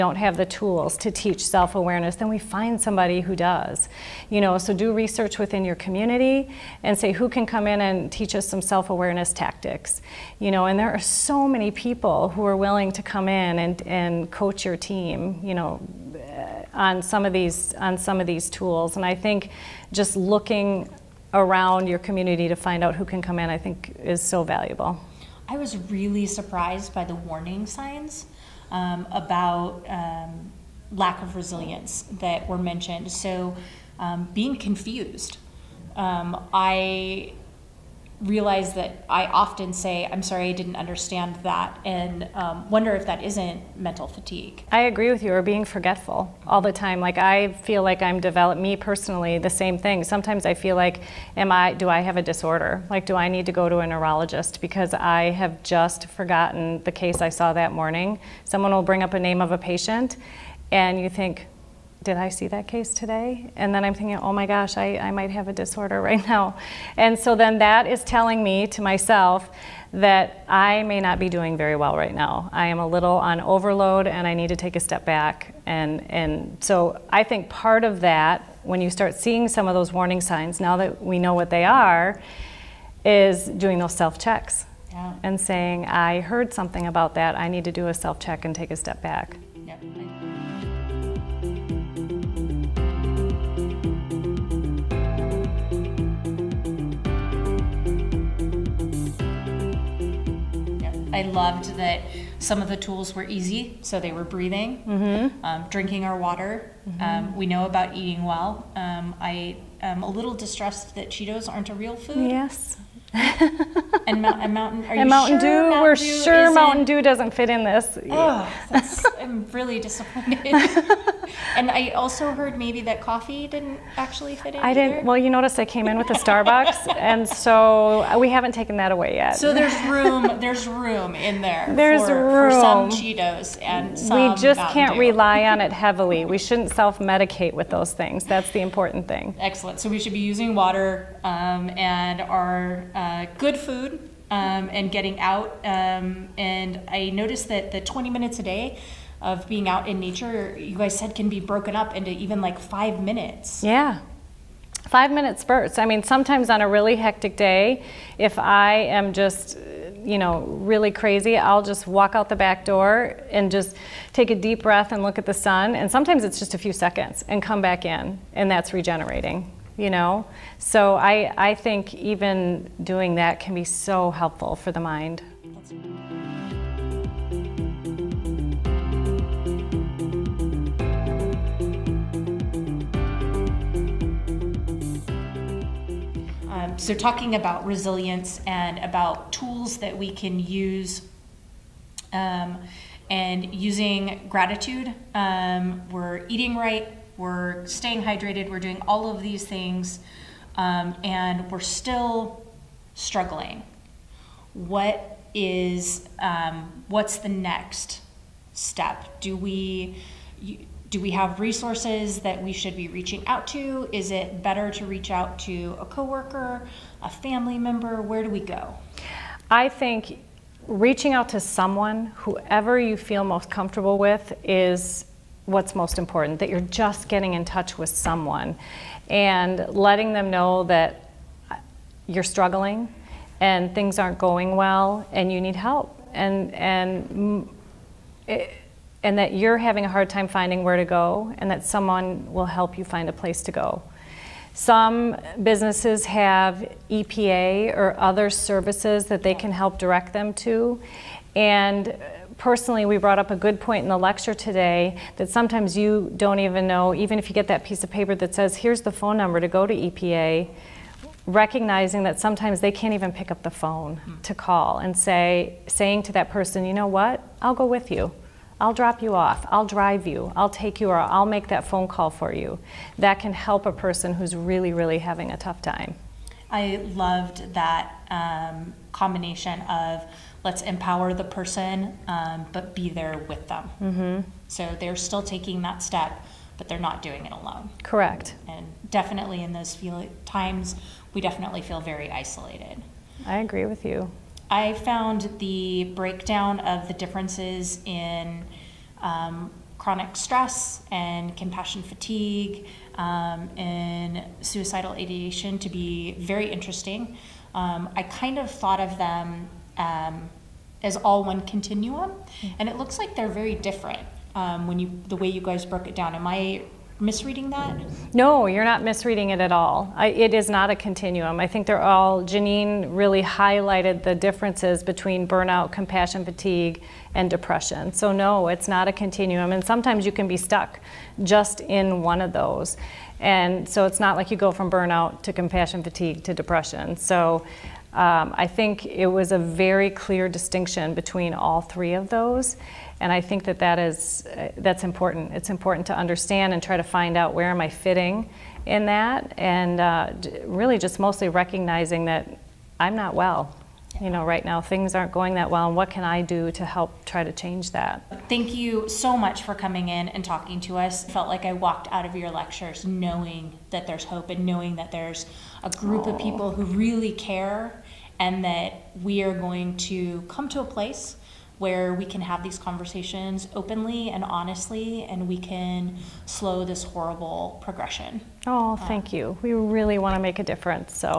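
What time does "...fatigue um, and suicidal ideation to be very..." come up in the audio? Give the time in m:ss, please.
5:01.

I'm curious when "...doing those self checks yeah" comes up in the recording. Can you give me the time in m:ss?
1:23.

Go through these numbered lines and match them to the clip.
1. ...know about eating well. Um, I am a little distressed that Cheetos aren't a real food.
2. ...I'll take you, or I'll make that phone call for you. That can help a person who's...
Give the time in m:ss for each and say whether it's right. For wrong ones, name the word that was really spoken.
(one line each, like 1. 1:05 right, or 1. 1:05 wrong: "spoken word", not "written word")
1. 1:47 right
2. 4:30 right.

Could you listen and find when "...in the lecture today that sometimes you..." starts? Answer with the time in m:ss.
4:13.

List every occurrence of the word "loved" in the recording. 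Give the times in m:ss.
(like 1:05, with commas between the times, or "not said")
1:41, 4:36.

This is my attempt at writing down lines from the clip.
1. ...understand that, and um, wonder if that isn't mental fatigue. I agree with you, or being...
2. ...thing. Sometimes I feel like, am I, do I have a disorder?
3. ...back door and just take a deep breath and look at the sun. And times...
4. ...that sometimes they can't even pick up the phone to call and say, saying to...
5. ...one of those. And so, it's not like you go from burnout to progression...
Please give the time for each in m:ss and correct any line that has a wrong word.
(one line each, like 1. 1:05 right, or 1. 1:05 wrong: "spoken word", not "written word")
1. 0:40 right
2. 0:49 right
3. 2:42 wrong: "sometimes", not "times"
4. 4:22 right
5. 5:32 wrong: "compassion", not "progression".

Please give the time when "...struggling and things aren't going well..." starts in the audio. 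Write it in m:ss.
3:52.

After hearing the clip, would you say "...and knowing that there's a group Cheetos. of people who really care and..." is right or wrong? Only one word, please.
wrong.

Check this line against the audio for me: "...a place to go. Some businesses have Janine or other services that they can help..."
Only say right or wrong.
wrong.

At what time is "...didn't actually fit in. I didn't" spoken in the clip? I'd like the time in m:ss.
2:03.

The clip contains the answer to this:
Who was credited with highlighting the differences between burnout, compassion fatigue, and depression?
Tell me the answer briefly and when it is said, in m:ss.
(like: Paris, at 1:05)
Janine, at 5:22.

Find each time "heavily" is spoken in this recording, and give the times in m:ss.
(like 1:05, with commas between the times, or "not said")
2:15.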